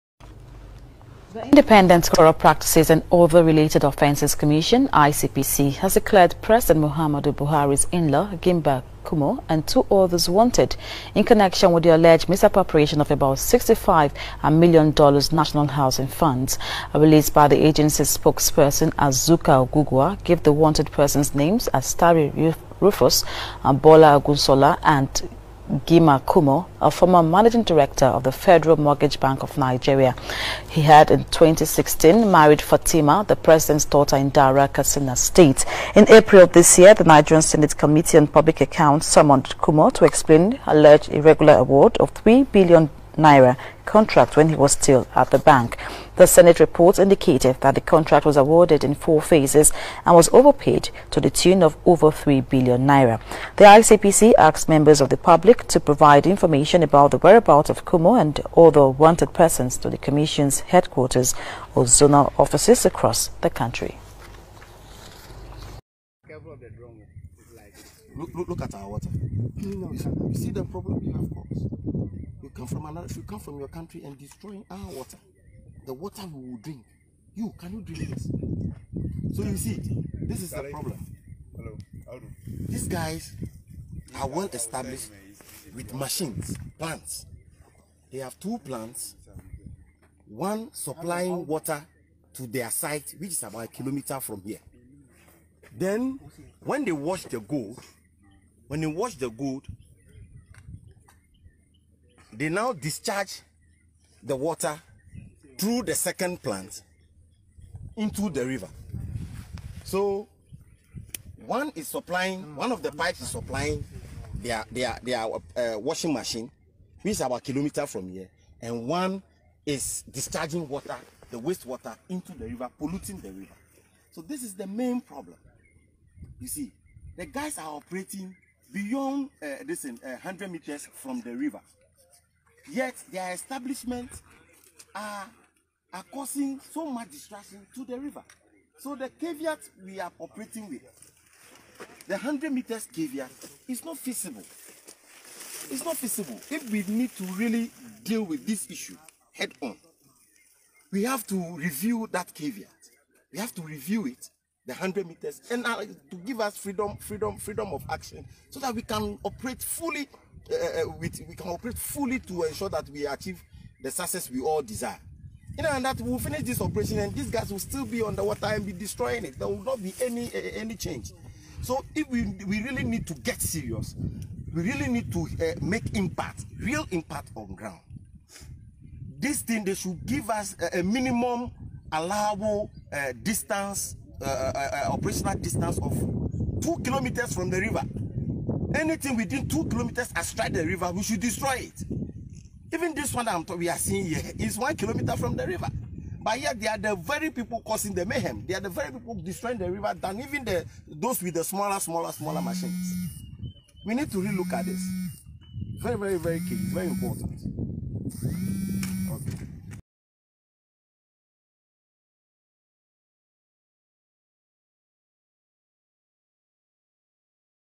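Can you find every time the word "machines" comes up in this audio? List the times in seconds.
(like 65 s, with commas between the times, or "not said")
85 s, 116 s, 202 s.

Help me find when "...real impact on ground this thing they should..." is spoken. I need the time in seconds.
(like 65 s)
176 s.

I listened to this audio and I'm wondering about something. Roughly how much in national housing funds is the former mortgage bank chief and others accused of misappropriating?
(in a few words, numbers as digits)
$65 million.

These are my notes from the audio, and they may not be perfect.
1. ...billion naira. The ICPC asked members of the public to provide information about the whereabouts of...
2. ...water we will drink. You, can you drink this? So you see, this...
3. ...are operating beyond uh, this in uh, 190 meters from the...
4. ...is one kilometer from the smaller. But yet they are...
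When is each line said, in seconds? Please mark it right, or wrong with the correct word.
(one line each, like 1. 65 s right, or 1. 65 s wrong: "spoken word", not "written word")
1. 52 s right
2. 75 s right
3. 127 s wrong: "100", not "190"
4. 194 s wrong: "river", not "smaller".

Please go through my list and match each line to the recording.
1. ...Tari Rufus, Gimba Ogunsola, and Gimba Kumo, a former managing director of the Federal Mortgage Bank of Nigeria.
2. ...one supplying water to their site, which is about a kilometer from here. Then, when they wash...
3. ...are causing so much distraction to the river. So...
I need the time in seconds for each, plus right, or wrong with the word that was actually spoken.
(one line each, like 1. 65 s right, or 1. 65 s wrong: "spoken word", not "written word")
1. 21 s wrong: "Bola", not "Gimba"
2. 90 s right
3. 135 s right.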